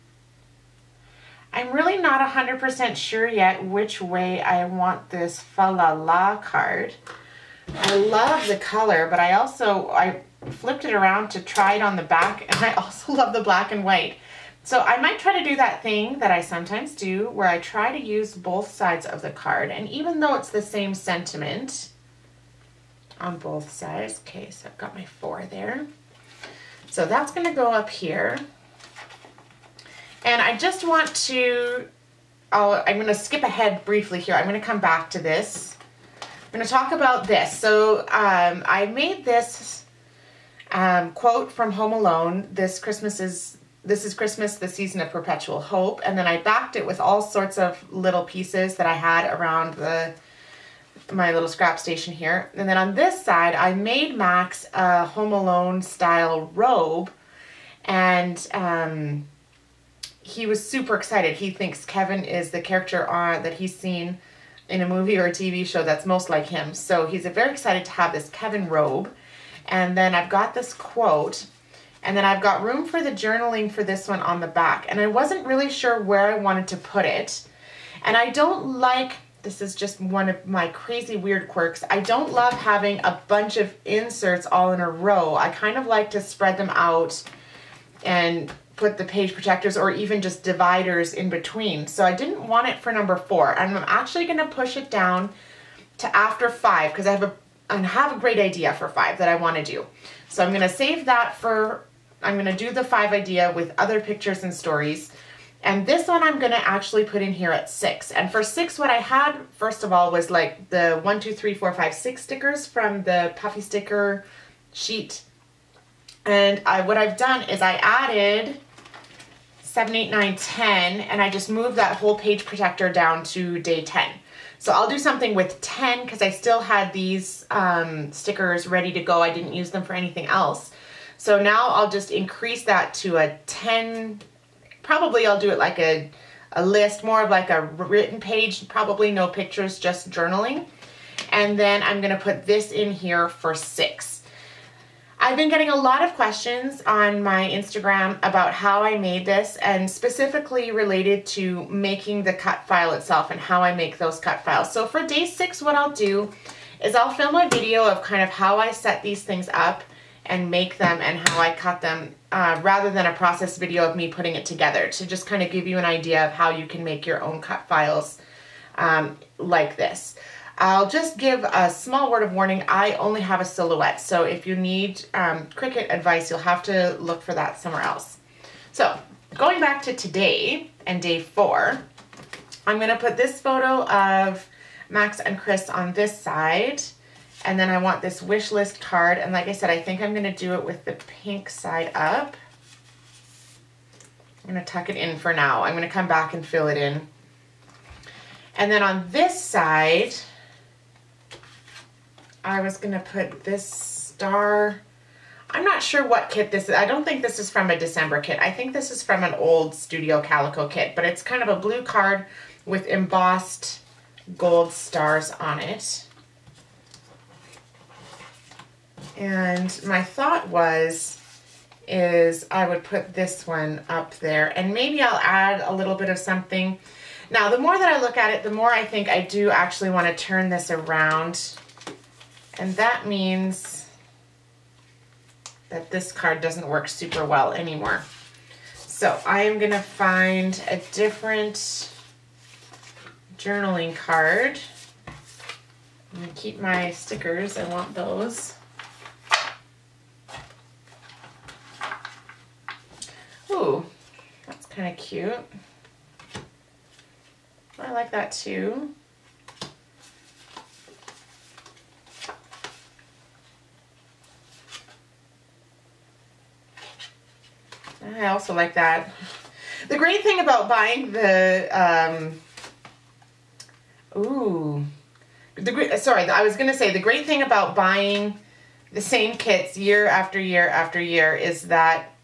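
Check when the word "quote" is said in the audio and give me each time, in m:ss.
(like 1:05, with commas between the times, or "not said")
0:41, 1:10.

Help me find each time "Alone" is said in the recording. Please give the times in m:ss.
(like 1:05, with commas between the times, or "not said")
0:41, 0:55.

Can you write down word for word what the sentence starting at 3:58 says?
So I am going to find a different journaling card.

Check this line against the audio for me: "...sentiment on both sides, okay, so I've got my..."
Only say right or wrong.
right.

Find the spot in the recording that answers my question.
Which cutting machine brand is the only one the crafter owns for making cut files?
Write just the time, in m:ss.
2:53.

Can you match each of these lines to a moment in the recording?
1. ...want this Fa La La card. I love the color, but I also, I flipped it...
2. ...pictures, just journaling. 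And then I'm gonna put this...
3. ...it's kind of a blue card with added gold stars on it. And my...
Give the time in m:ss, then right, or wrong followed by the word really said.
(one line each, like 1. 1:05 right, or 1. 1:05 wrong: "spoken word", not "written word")
1. 0:04 right
2. 2:19 right
3. 3:31 wrong: "embossed", not "added".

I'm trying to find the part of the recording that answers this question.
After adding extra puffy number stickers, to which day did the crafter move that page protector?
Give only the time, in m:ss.
2:03.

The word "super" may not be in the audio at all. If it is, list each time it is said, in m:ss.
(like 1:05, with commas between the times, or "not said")
1:00, 3:56.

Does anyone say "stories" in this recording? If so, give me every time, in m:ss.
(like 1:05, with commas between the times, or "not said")
1:44.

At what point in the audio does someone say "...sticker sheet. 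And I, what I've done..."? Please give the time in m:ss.
1:53.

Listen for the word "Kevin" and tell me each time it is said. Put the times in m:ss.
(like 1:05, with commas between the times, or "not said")
1:01, 1:08.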